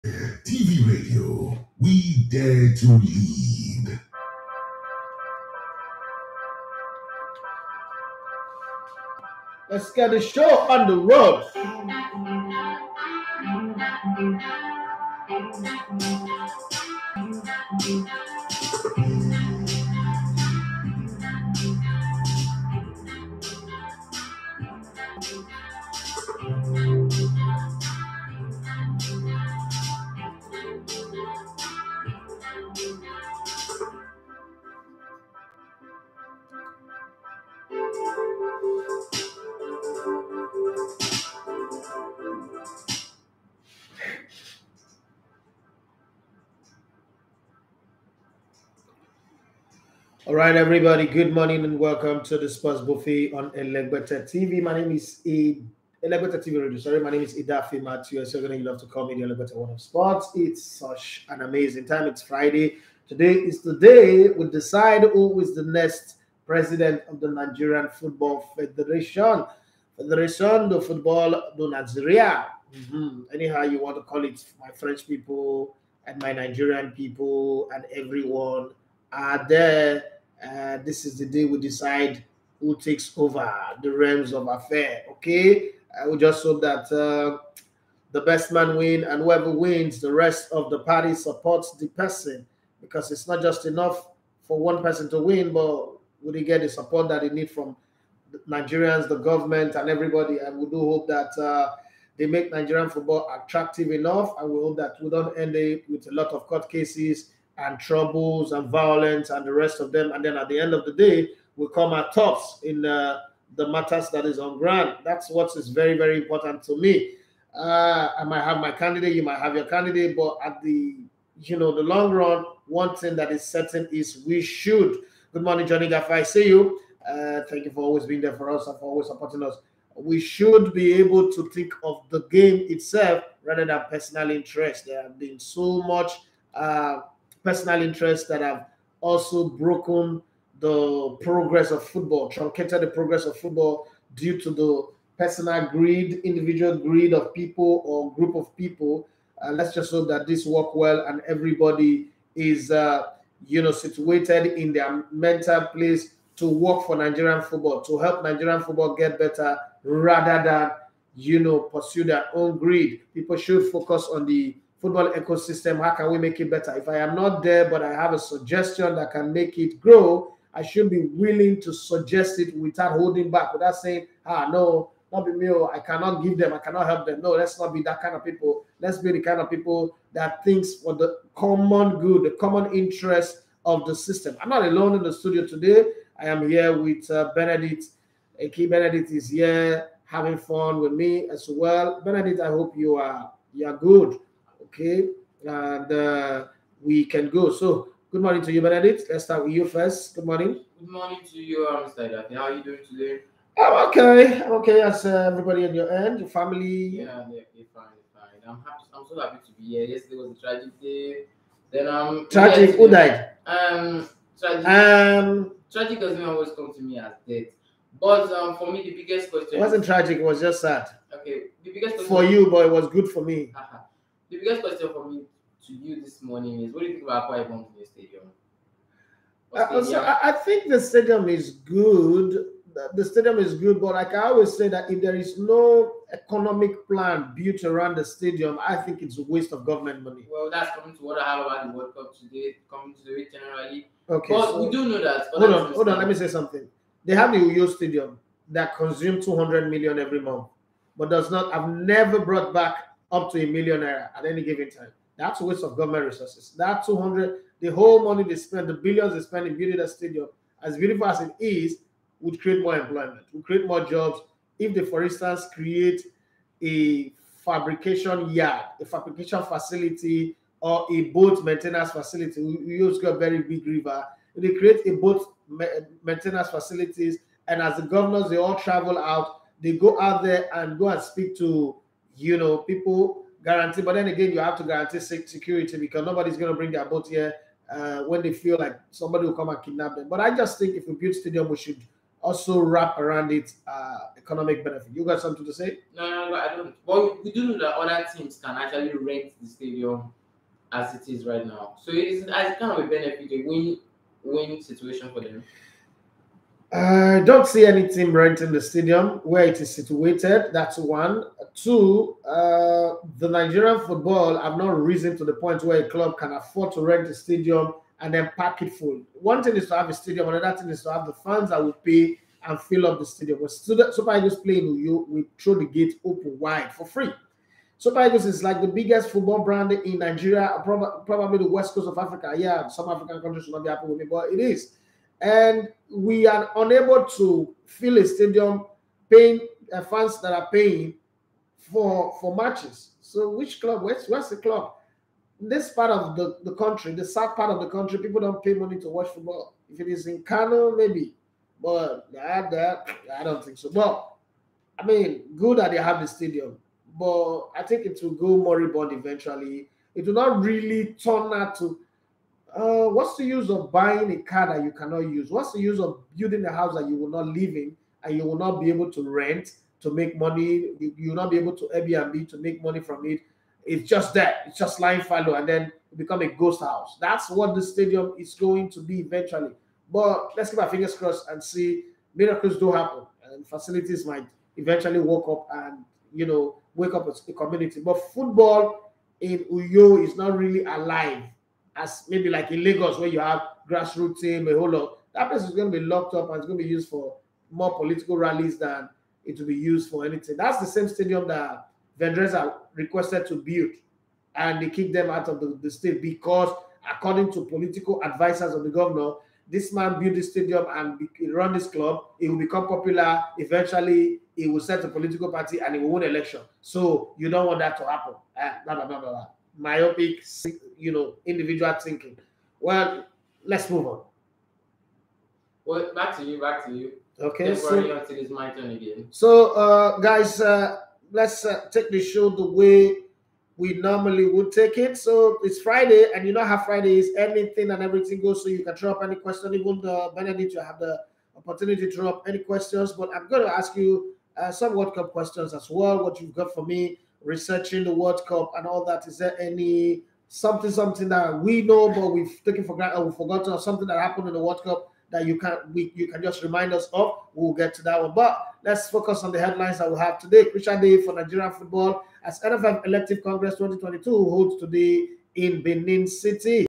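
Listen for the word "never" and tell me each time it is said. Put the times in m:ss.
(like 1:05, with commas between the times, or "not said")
4:11.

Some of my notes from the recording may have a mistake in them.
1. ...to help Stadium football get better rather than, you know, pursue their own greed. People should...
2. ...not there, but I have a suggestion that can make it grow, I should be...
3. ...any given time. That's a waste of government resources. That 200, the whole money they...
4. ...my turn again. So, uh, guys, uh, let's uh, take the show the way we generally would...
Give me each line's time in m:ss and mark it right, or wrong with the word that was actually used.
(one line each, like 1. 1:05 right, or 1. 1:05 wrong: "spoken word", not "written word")
1. 2:37 wrong: "Nigerian", not "Stadium"
2. 2:47 right
3. 4:14 right
4. 7:08 wrong: "normally", not "generally".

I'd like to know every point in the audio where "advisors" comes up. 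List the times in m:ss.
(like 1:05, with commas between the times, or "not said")
6:48.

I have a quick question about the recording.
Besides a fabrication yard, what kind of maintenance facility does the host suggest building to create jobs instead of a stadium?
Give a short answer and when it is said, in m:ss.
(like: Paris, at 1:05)
Boat maintenance facility, at 4:31.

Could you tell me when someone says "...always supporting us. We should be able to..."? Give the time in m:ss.
2:08.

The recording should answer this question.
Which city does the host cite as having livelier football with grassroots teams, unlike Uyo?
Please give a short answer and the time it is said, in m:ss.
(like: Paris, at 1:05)
Lagos, at 6:32.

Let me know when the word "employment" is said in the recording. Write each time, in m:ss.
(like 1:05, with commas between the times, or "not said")
4:22.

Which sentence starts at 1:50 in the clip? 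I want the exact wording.
And then at the end of the day, we come at tops in uh, the matters that is on ground.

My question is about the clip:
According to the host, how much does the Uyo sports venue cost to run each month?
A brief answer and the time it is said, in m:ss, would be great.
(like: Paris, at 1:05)
200 million, at 4:09.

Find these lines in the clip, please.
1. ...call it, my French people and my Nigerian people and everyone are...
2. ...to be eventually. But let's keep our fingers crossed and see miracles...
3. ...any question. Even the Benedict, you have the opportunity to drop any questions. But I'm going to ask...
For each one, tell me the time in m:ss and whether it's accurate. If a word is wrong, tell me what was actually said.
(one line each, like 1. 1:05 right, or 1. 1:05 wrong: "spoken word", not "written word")
1. 1:14 right
2. 6:18 right
3. 7:19 right.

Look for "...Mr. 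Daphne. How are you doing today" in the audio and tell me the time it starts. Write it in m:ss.
3:21.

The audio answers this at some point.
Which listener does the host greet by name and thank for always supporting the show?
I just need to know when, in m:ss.
2:05.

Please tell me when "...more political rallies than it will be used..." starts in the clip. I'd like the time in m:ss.
6:37.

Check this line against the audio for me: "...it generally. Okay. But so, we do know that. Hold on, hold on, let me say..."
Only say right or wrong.
right.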